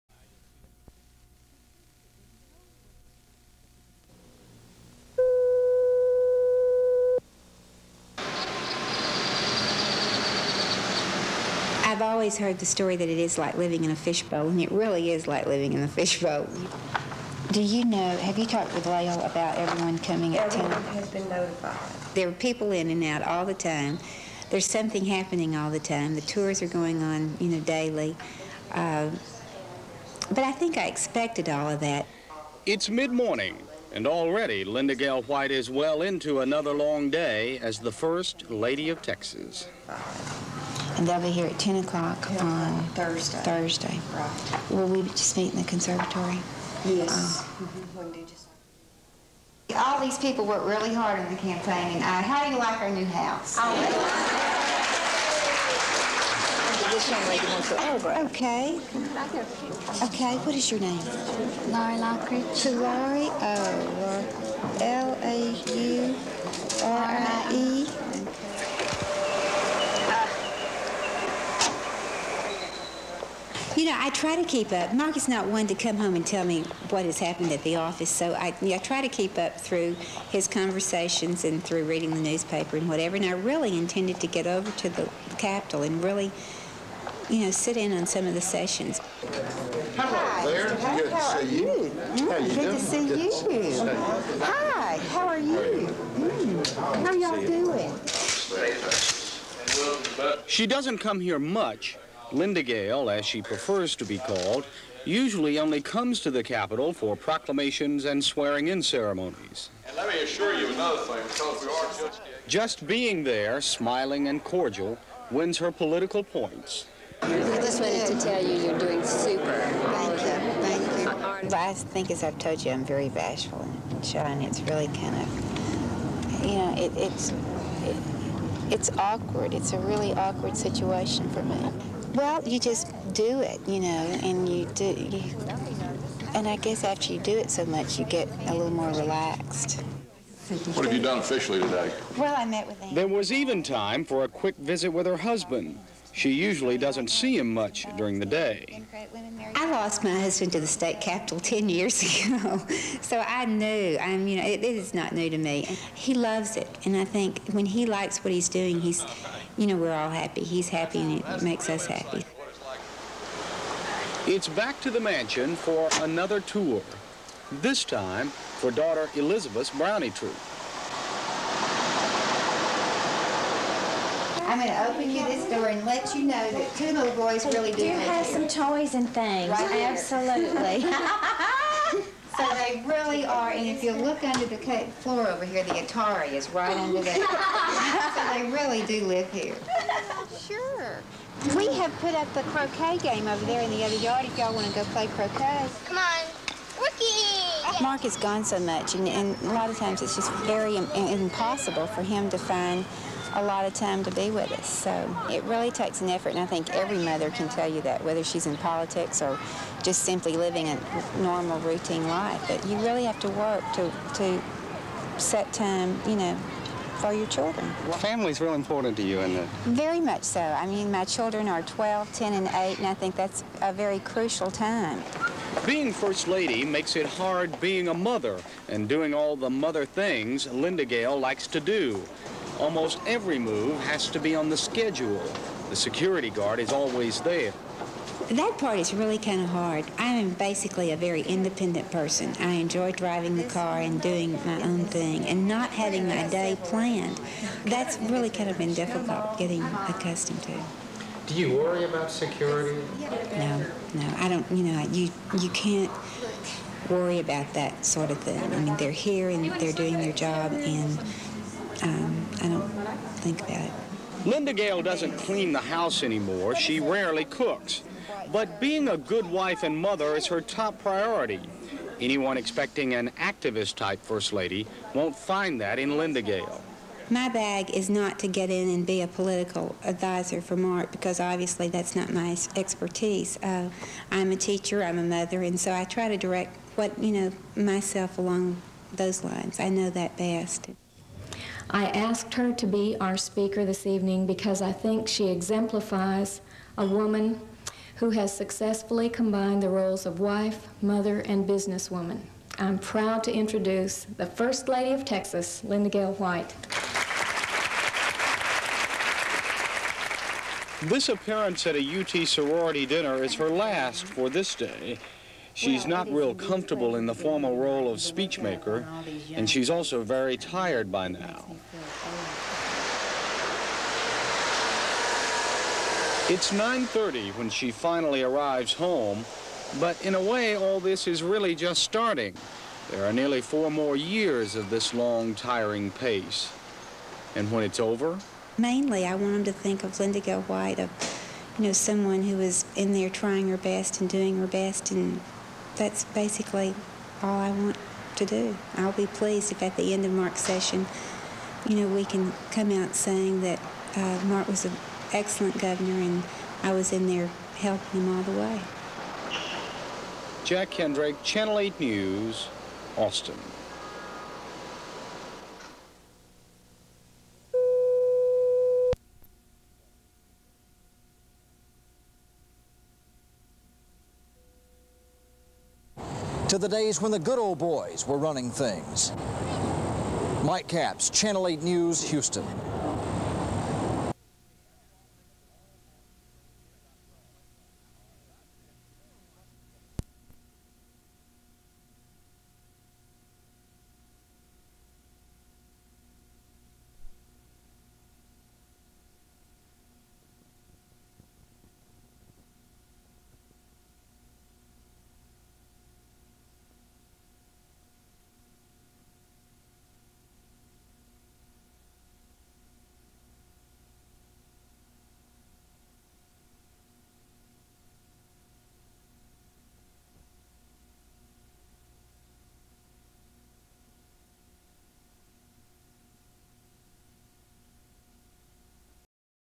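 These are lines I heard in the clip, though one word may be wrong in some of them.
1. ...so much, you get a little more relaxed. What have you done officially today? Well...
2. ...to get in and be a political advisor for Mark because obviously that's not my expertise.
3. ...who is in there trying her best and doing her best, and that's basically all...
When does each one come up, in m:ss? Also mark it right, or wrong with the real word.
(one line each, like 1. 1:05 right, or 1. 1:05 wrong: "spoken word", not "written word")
1. 2:17 right
2. 4:38 right
3. 5:42 right.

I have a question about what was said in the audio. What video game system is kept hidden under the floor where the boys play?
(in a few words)
Atari.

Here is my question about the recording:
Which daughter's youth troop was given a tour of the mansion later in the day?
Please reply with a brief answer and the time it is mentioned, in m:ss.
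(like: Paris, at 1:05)
Elizabeth, at 2:49.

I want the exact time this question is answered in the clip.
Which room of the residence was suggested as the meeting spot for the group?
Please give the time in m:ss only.
0:45.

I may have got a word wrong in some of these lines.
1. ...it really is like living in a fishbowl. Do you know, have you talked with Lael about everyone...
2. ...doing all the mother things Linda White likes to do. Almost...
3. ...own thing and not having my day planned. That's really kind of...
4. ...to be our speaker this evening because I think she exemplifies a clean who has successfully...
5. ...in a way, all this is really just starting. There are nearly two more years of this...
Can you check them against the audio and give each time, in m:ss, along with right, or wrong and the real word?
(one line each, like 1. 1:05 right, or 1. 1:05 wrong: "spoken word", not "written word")
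1. 0:14 right
2. 3:48 wrong: "Gale", not "White"
3. 4:04 right
4. 4:52 wrong: "woman", not "clean"
5. 5:30 wrong: "four", not "two".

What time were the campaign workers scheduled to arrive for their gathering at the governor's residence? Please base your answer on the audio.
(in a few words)
10 o'clock.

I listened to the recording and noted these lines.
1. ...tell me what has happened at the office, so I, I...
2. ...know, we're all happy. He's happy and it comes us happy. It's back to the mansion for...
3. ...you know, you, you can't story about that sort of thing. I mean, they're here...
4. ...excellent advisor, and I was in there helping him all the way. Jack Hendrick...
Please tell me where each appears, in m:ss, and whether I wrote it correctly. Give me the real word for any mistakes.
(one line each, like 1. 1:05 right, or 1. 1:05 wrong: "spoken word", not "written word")
1. 1:16 right
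2. 2:39 wrong: "makes", not "comes"
3. 4:14 wrong: "worry", not "story"
4. 5:55 wrong: "governor", not "advisor".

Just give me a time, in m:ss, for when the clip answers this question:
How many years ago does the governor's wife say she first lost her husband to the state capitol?
2:31.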